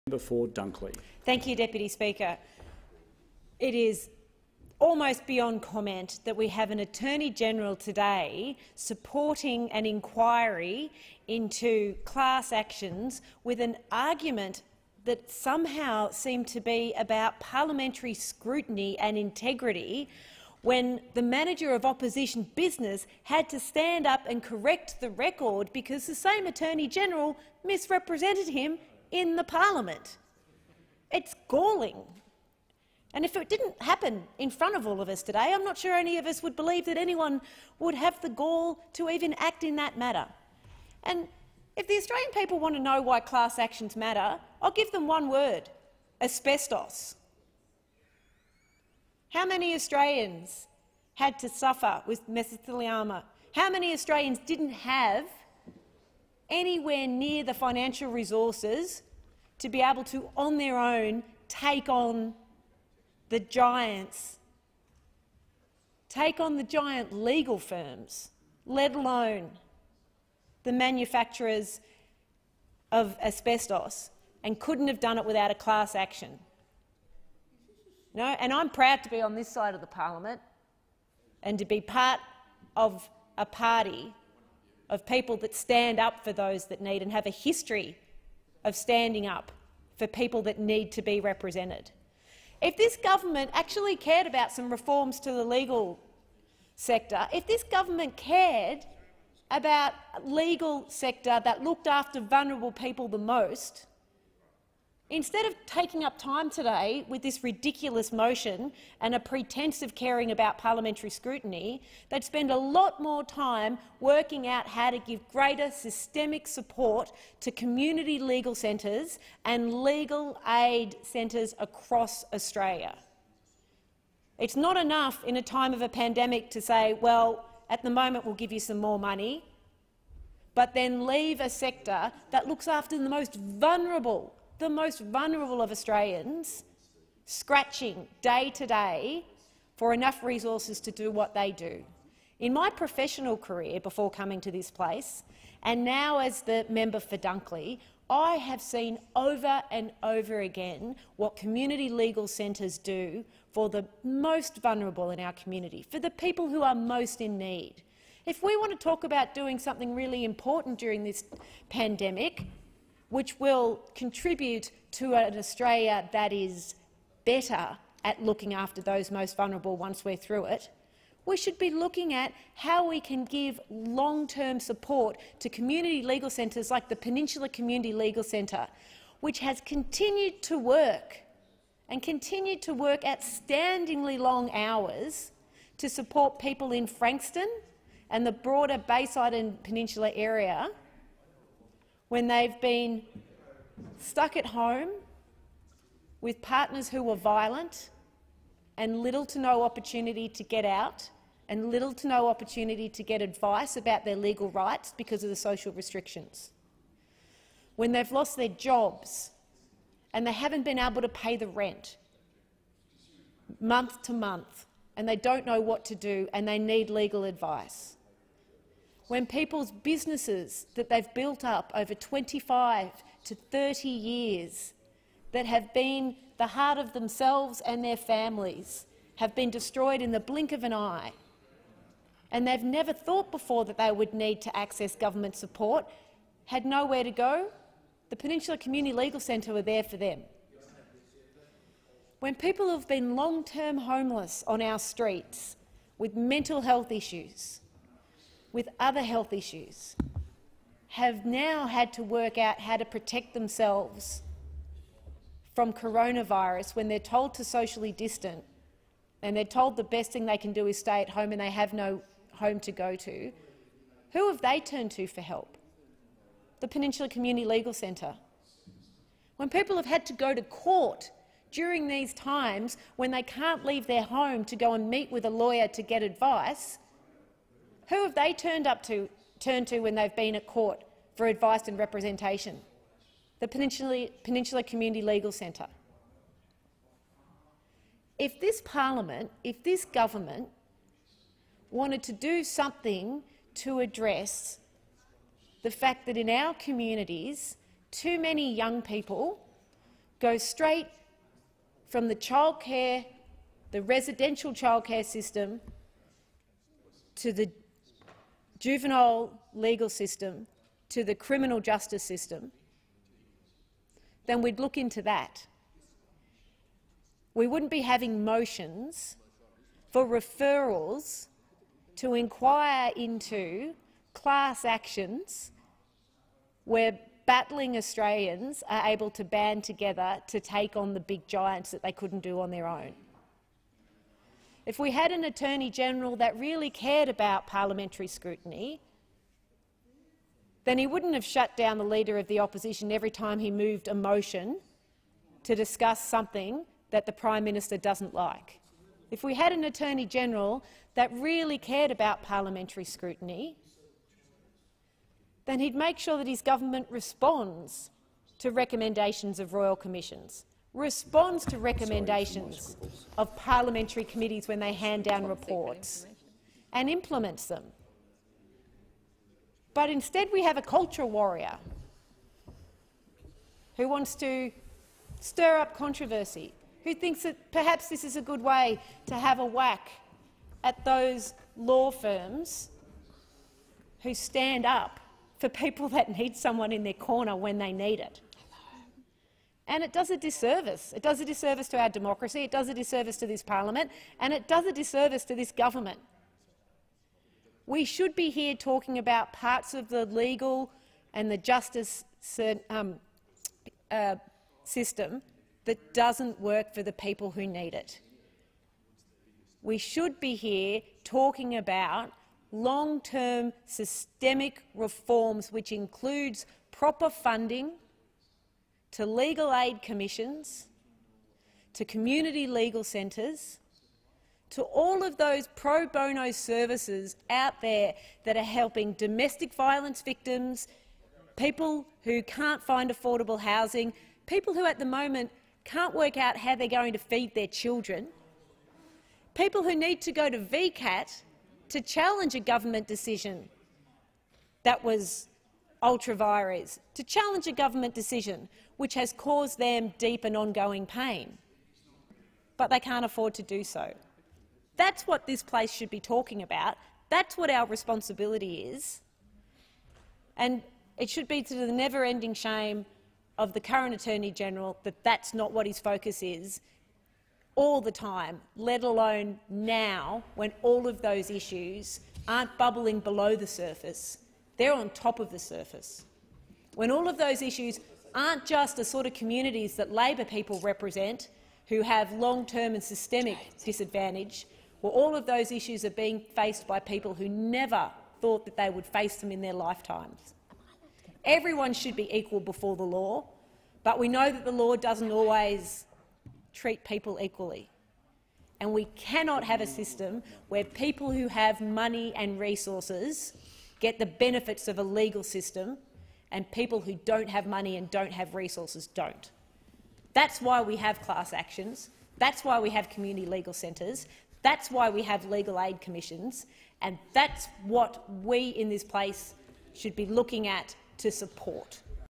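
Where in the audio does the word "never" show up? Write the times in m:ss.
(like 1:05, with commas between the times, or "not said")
3:52, 7:41, 8:07.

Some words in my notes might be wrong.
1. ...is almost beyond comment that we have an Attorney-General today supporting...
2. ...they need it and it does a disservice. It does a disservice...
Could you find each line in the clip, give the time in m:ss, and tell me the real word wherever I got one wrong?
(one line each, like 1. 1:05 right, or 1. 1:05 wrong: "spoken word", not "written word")
1. 0:03 right
2. 6:27 right.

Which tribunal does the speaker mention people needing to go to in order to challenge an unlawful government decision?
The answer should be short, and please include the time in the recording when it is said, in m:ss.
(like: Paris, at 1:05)
VCAT, at 7:20.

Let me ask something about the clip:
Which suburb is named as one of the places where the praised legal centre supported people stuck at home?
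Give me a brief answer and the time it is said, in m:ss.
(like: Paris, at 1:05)
Frankston, at 3:06.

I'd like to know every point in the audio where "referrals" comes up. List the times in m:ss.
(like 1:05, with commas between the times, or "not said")
5:20.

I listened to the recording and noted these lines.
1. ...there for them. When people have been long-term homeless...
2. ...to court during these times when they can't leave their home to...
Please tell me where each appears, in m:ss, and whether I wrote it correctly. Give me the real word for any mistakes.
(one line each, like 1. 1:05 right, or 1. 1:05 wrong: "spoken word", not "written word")
1. 3:59 right
2. 4:30 right.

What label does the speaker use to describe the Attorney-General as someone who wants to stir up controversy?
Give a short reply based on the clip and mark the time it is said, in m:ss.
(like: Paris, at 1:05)
culture warrior, at 6:10.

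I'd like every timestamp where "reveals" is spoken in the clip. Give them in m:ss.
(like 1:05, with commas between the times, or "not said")
not said.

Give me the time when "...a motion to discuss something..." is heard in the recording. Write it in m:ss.
5:43.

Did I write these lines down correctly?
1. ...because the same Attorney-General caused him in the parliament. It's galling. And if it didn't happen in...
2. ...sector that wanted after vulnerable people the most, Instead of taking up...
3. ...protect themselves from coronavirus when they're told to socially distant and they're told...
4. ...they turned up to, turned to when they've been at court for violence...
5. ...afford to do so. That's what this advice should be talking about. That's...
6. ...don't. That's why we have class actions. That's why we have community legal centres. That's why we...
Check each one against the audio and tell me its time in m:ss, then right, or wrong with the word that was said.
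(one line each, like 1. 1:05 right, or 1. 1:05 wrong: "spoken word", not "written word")
1. 0:25 wrong: "misrepresented", not "caused"
2. 1:40 wrong: "looked", not "wanted"
3. 4:12 right
4. 4:38 wrong: "advice", not "violence"
5. 7:33 wrong: "place", not "advice"
6. 8:28 right.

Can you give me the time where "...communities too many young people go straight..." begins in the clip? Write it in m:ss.
4:56.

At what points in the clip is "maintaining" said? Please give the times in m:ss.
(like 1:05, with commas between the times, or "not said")
not said.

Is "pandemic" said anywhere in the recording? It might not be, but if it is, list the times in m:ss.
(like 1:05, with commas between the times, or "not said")
2:05, 2:41.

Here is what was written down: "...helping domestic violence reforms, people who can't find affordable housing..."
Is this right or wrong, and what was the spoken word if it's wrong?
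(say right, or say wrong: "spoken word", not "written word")
wrong: "victims", not "reforms".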